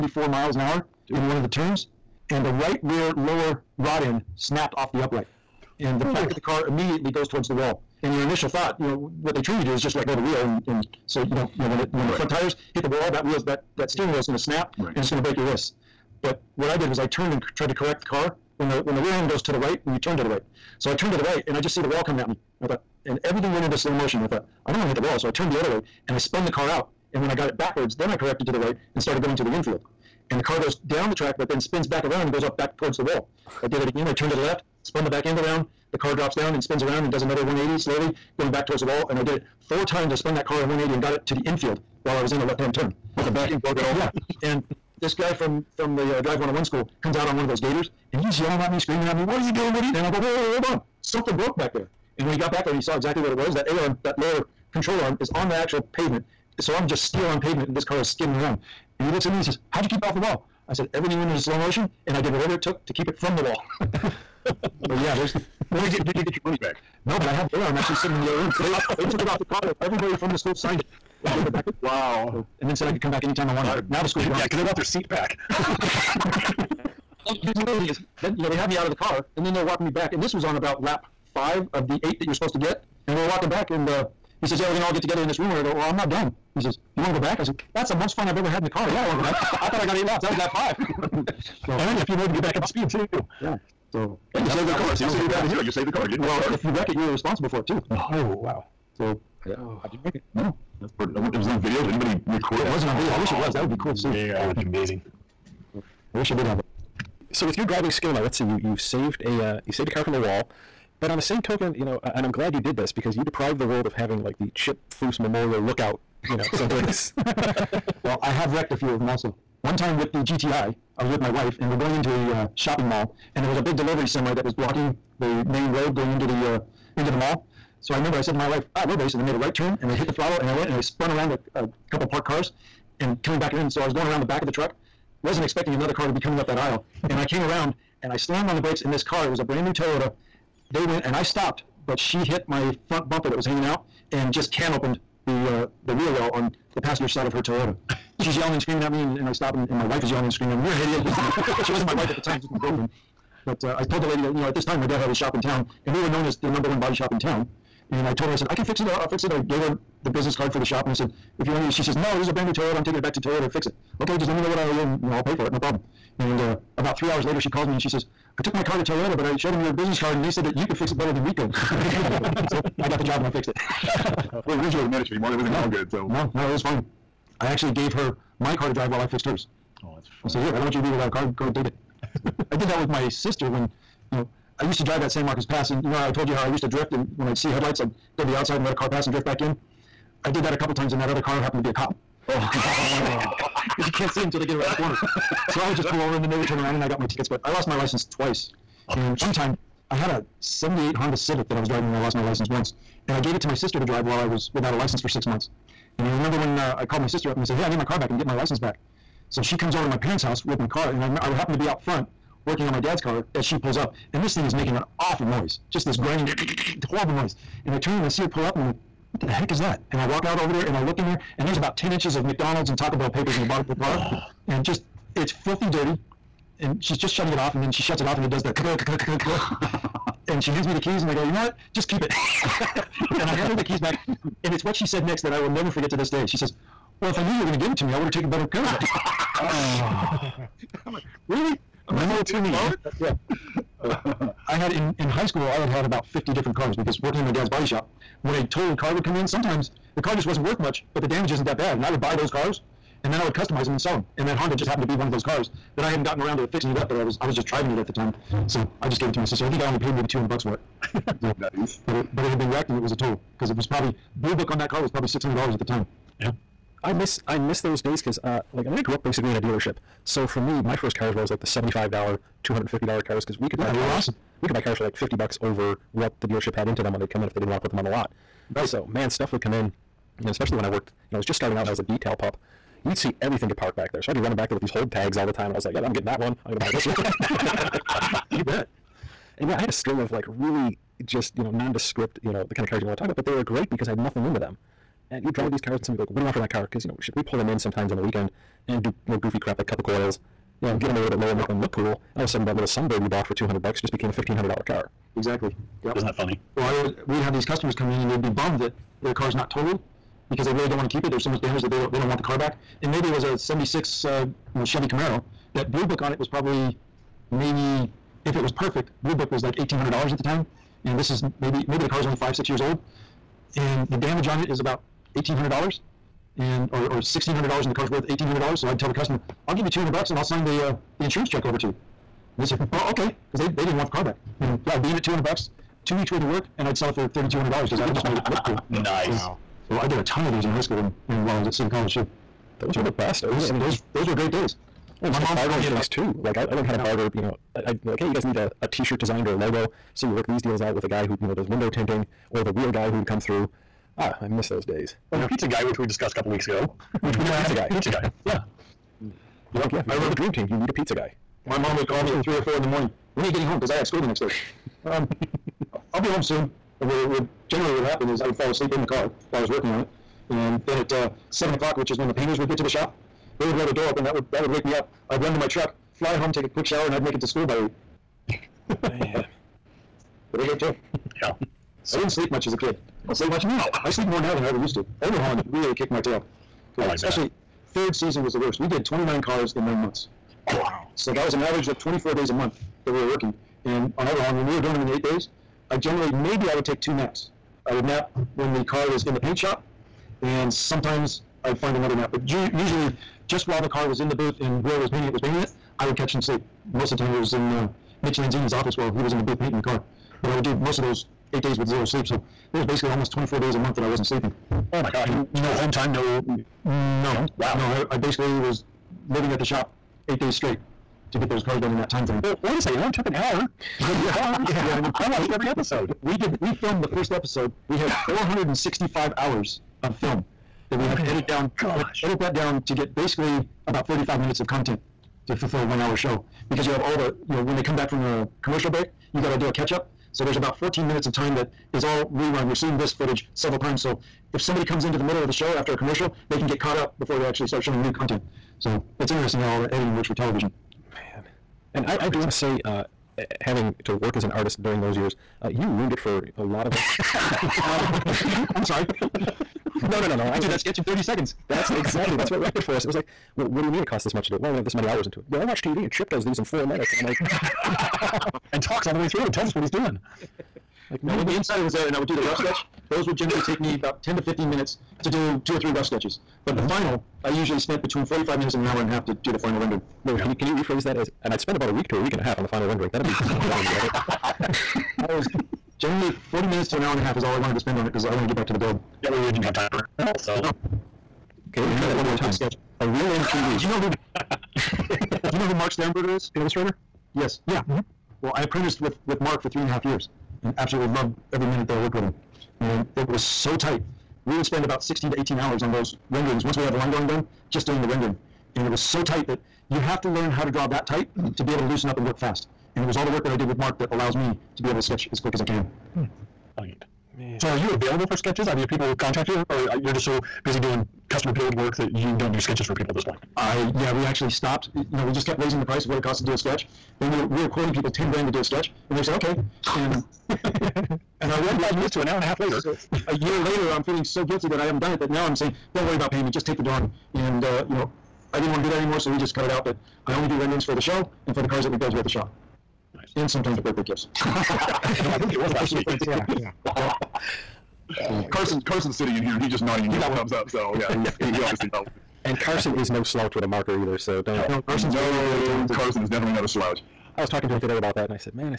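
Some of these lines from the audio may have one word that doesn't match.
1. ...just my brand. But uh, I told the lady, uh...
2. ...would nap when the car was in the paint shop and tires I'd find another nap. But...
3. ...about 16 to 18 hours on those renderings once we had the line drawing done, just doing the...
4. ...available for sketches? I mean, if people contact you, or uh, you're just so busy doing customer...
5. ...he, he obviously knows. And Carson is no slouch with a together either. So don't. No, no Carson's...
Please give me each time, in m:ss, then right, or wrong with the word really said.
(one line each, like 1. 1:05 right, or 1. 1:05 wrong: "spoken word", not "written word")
1. 2:32 wrong: "girlfriend", not "brand"
2. 6:37 wrong: "sometimes", not "tires"
3. 8:24 right
4. 8:37 right
5. 9:11 wrong: "marker", not "together".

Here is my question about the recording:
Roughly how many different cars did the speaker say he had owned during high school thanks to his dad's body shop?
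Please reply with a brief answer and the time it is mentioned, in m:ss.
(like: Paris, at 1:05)
50, at 4:06.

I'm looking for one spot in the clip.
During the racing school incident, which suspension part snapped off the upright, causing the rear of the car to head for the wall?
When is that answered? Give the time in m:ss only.
0:02.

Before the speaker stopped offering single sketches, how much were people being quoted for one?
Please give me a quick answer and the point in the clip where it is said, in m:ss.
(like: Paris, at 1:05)
$10,000, at 8:47.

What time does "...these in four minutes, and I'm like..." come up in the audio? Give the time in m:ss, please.
7:46.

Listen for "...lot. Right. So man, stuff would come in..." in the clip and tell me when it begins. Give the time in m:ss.
4:37.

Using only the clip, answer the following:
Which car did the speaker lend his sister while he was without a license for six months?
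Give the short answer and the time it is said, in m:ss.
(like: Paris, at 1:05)
'78 Honda Civic, at 3:20.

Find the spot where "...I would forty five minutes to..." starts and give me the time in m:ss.
8:51.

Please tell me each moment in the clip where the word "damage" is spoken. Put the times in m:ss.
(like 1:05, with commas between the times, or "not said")
4:11, 5:11, 5:23.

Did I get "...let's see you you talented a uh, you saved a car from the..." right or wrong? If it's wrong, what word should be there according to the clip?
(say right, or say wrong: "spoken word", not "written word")
wrong: "saved", not "talented".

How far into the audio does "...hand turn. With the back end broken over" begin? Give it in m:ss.
0:42.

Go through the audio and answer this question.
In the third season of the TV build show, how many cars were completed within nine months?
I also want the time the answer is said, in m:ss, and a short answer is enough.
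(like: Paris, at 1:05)
29, at 6:28.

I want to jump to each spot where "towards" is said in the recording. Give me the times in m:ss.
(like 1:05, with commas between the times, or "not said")
0:07, 0:32, 0:38.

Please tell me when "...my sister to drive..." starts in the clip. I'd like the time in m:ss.
3:23.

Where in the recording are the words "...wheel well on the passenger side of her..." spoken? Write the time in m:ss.
2:25.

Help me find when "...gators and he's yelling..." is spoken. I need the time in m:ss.
0:47.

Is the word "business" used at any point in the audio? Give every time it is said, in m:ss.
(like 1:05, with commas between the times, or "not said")
2:40, 2:49.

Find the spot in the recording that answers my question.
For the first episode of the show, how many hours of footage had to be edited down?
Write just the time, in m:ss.
7:08.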